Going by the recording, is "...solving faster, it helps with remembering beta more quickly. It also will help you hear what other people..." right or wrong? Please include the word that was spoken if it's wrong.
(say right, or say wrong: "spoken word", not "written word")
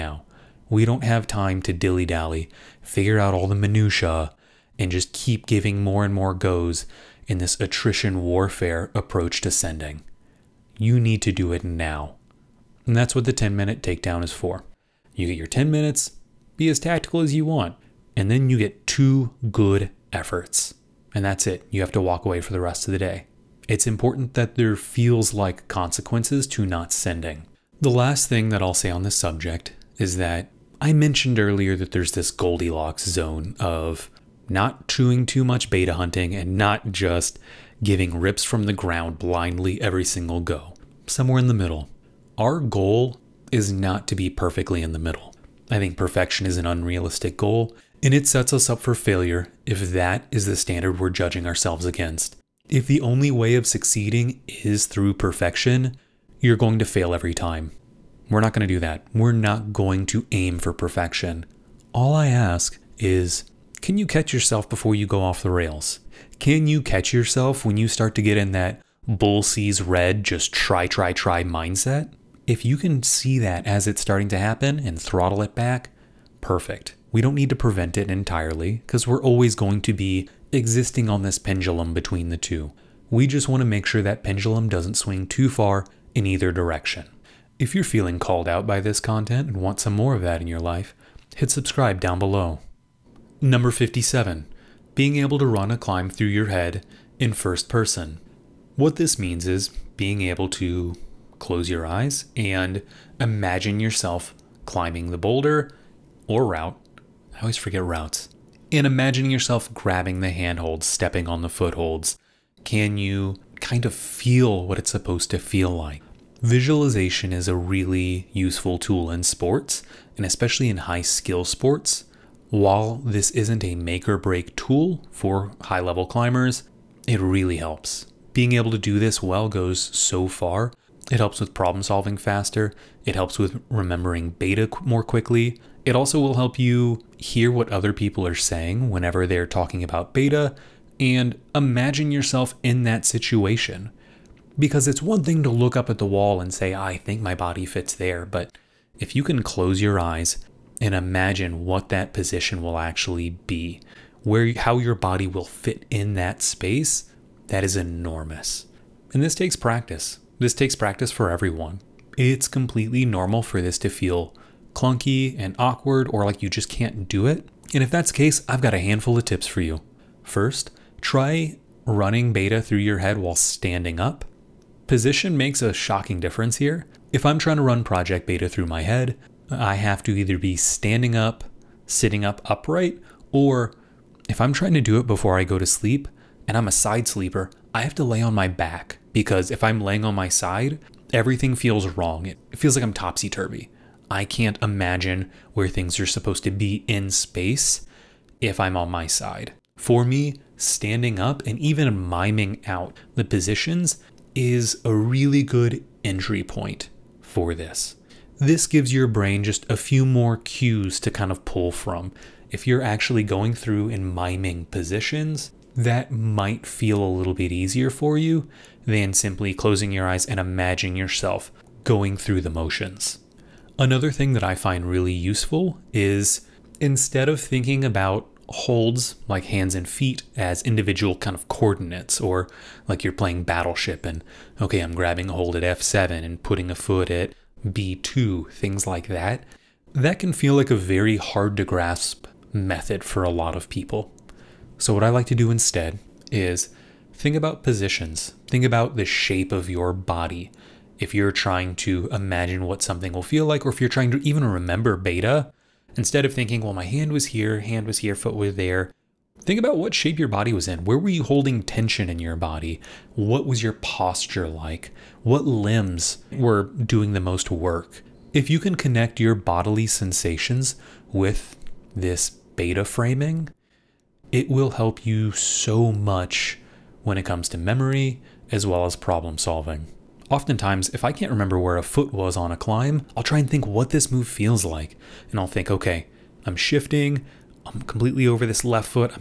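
right.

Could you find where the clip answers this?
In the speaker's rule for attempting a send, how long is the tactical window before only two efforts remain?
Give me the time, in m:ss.
0:15.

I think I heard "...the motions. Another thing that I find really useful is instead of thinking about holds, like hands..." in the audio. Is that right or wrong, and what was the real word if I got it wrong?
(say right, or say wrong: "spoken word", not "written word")
right.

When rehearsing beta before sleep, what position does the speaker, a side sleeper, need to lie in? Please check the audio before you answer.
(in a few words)
On my back.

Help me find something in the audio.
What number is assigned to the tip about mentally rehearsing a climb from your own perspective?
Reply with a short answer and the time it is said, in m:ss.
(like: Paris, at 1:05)
57, at 1:33.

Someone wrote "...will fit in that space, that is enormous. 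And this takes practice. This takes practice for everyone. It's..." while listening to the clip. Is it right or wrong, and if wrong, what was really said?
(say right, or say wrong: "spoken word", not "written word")
right.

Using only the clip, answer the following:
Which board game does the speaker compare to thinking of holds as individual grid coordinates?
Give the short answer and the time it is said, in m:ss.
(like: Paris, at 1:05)
Battleship, at 3:53.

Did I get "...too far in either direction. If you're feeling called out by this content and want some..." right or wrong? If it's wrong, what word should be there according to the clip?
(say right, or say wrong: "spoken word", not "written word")
right.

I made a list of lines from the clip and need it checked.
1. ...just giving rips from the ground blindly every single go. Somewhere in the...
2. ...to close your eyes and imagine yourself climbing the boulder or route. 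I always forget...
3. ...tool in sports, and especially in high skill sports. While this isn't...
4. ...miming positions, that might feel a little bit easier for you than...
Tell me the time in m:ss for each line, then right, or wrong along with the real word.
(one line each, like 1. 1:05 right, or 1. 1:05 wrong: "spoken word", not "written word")
1. 0:36 right
2. 1:40 right
3. 1:58 right
4. 3:34 right.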